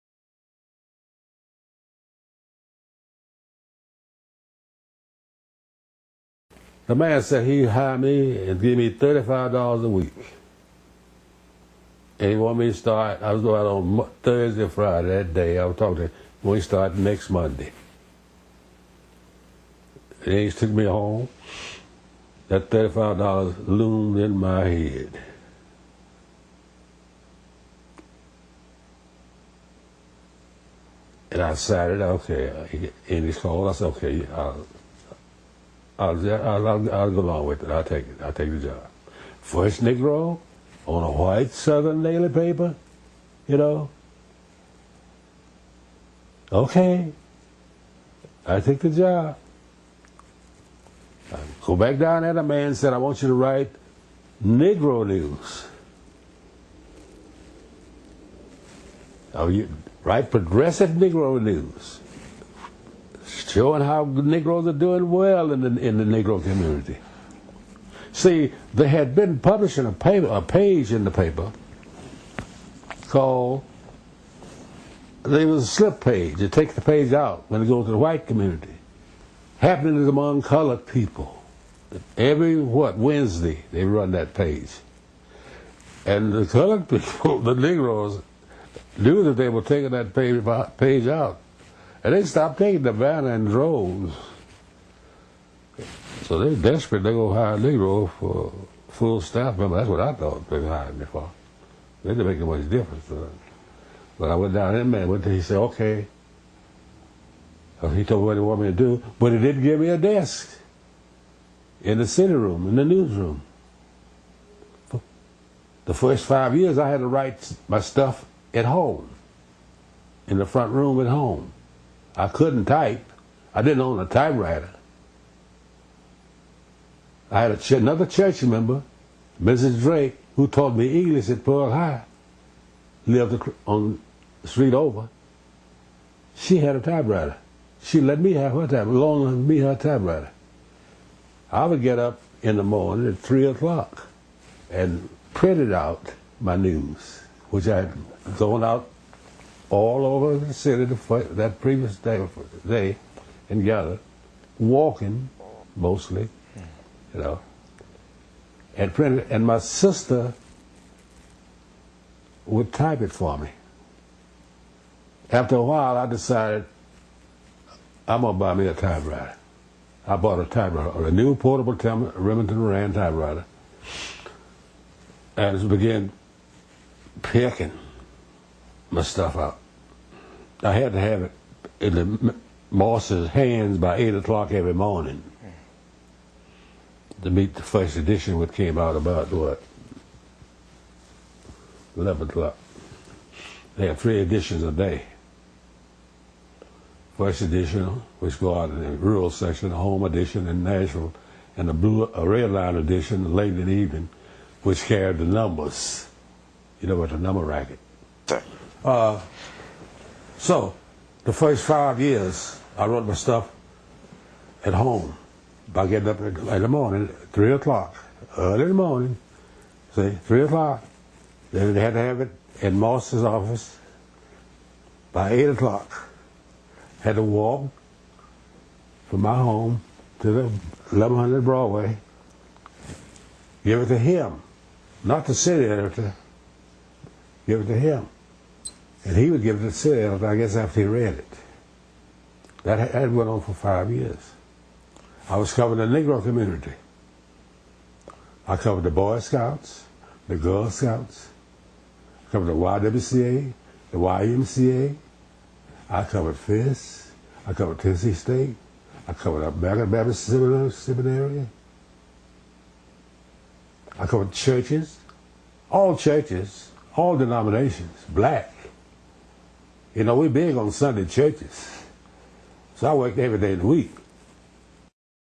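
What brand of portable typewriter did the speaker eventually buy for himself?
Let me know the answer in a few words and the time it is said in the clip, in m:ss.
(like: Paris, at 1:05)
Remington Rand, at 2:51.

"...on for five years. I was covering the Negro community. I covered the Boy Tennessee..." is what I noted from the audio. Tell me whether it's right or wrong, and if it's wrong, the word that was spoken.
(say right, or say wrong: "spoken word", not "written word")
wrong: "Scouts", not "Tennessee".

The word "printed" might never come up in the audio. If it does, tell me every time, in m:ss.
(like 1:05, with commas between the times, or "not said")
2:25, 2:38.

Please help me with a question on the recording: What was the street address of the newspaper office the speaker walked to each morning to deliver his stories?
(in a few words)
1100 Broadway.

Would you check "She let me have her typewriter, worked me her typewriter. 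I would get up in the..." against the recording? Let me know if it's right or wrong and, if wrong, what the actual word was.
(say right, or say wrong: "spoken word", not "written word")
wrong: "loaned", not "worked".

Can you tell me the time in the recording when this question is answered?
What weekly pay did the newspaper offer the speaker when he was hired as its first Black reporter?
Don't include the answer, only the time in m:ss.
0:08.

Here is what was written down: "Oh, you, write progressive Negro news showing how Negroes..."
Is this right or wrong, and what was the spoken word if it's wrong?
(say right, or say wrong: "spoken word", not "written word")
right.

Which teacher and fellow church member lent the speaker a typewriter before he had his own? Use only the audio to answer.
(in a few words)
Mrs. Drake.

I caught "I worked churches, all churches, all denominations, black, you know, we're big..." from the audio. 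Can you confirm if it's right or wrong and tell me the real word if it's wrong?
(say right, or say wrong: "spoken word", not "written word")
wrong: "covered", not "worked".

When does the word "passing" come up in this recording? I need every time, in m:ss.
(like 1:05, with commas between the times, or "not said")
not said.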